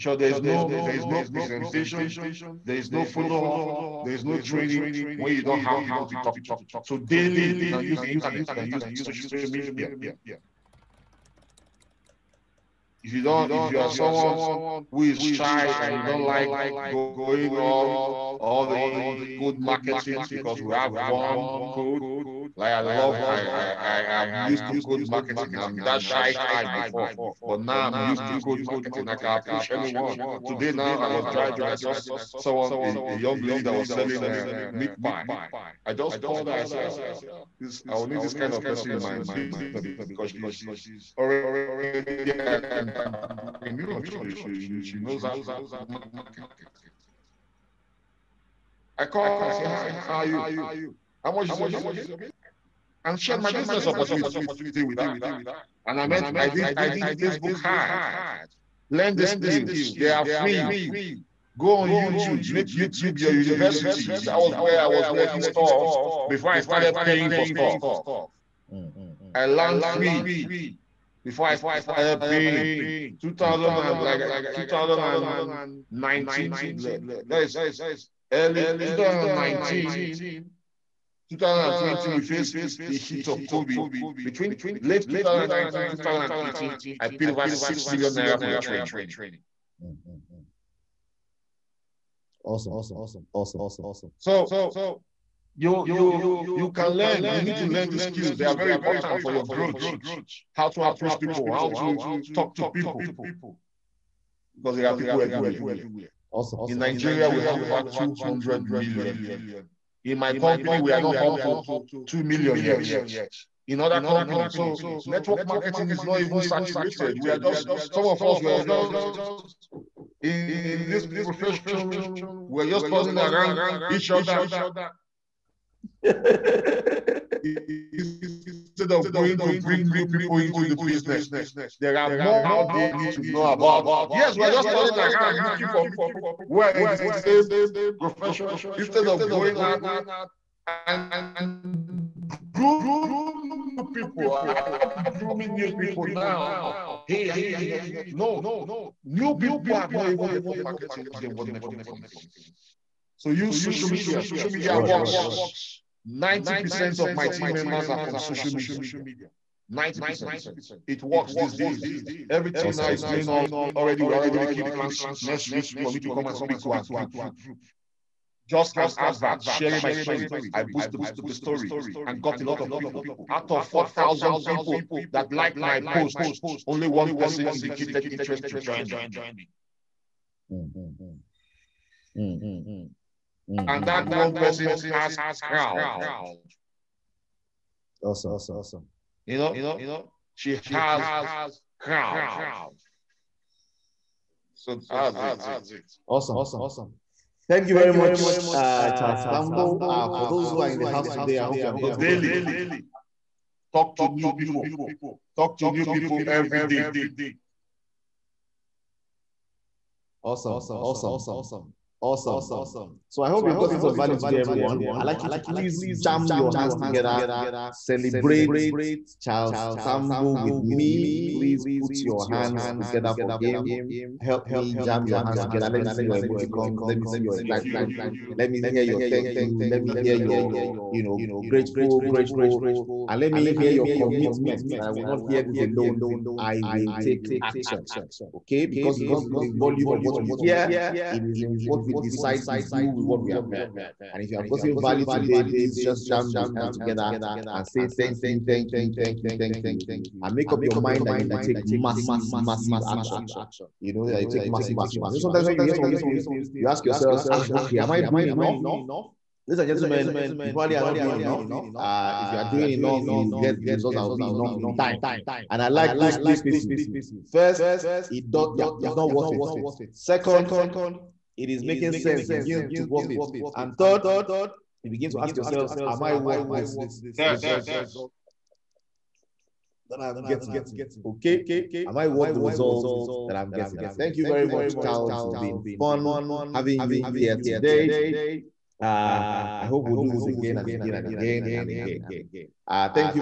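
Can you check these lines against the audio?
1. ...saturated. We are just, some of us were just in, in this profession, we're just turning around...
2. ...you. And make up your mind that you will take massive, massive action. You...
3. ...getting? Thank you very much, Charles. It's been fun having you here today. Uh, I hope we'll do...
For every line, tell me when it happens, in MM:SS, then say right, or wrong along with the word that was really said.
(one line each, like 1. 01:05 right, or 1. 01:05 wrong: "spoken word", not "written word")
1. 01:56 right
2. 04:09 right
3. 04:43 right.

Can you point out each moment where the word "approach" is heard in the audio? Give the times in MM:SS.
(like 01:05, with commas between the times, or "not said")
00:29, 01:40.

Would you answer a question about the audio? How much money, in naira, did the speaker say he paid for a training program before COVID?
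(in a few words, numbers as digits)
6 million naira.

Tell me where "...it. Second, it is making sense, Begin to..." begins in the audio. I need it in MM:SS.
04:29.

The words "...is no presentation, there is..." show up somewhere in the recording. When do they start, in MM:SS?
00:00.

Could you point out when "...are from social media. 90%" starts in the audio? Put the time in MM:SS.
02:37.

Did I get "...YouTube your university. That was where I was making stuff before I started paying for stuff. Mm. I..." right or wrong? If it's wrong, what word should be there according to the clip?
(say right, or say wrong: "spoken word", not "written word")
wrong: "learning", not "making".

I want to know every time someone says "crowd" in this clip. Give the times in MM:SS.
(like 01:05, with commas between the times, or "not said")
03:05, 03:11.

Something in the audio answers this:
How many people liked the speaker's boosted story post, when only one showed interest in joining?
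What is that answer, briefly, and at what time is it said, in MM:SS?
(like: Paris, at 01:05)
4,000, at 02:53.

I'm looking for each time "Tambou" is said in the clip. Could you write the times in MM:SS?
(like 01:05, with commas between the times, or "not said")
03:19, 03:39.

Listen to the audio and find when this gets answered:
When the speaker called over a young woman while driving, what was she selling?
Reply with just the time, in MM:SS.
00:34.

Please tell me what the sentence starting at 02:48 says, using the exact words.
Just an advert, sharing my story.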